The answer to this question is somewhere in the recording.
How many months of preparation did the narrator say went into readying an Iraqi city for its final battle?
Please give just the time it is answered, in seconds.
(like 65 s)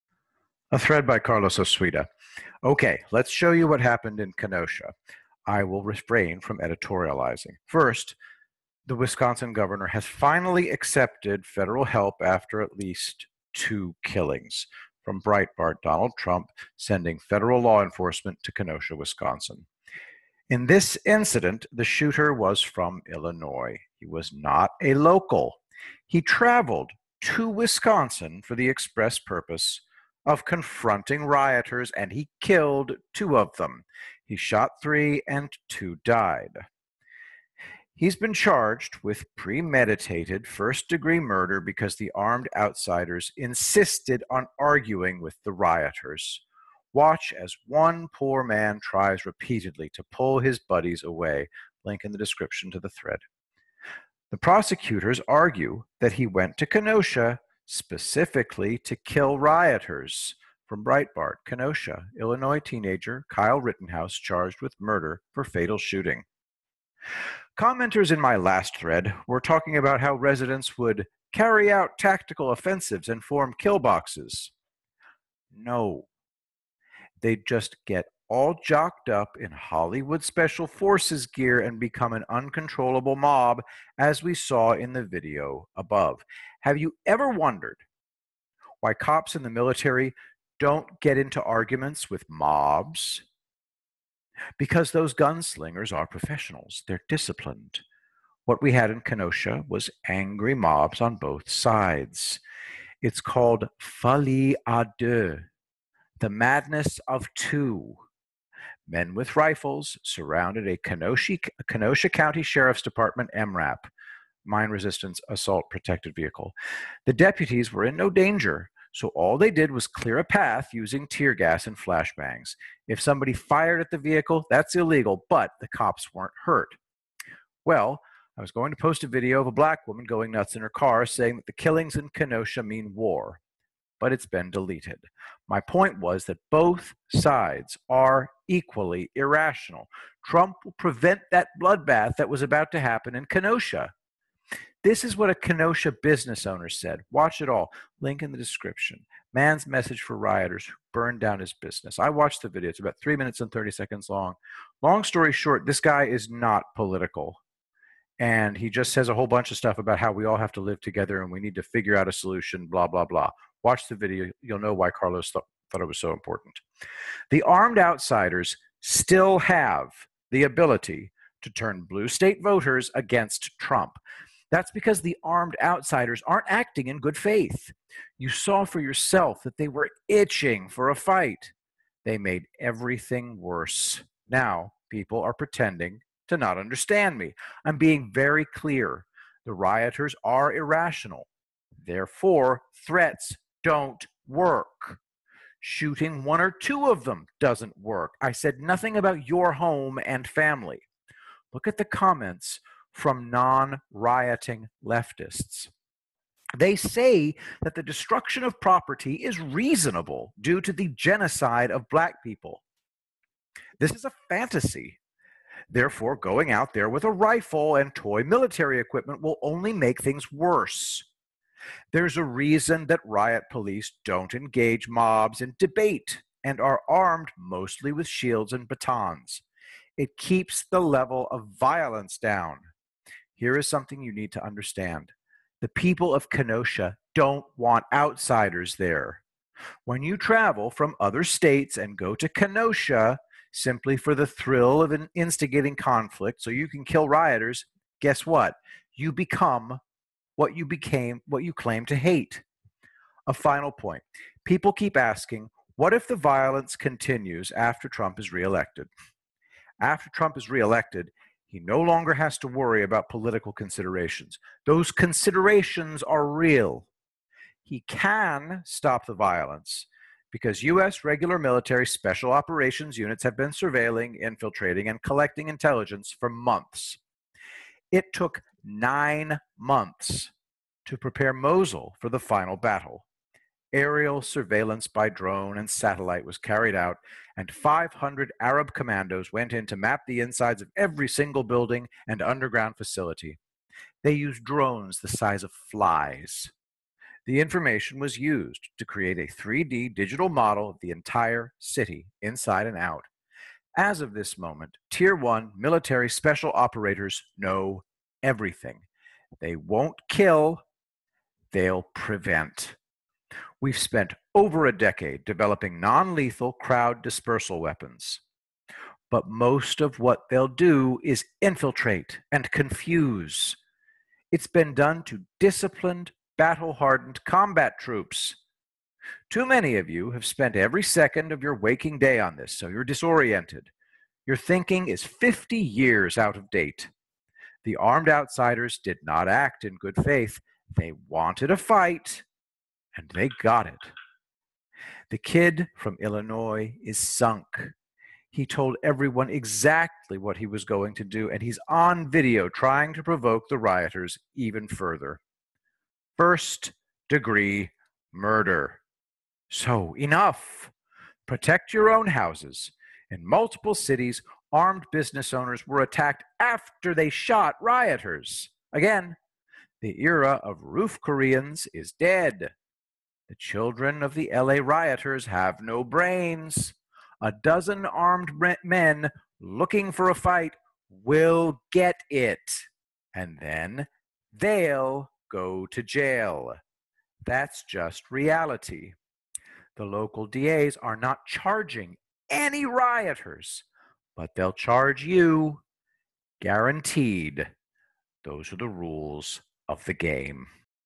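278 s.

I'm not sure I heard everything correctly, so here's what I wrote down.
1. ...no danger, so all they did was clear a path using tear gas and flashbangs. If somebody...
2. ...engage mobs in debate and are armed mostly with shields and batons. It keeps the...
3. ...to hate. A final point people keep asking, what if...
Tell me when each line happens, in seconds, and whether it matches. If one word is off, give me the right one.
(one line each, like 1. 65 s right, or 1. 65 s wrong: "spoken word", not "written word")
1. 117 s right
2. 224 s right
3. 251 s right.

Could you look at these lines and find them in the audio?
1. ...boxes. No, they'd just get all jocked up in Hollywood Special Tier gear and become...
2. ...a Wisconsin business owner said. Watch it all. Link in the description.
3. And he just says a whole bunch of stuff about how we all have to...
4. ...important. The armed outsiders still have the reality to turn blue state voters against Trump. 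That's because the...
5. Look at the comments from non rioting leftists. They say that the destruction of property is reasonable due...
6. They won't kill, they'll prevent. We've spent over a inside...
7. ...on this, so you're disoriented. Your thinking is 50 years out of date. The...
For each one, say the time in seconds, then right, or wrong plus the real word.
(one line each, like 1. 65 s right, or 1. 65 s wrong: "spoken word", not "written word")
1. 73 s wrong: "Forces", not "Tier"
2. 145 s wrong: "Kenosha", not "Wisconsin"
3. 158 s right
4. 166 s wrong: "ability", not "reality"
5. 201 s right
6. 309 s wrong: "decade", not "inside"
7. 332 s right.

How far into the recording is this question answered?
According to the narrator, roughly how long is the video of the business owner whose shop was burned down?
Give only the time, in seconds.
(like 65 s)
153 s.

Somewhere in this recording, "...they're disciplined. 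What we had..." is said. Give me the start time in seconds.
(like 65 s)
96 s.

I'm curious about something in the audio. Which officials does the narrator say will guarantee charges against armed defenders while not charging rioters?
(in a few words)
local DAs.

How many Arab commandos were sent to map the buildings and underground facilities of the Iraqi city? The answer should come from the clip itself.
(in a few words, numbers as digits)
500.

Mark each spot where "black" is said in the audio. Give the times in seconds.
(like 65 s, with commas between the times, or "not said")
129 s, 211 s.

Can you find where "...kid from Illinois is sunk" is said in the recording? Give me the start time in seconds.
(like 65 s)
345 s.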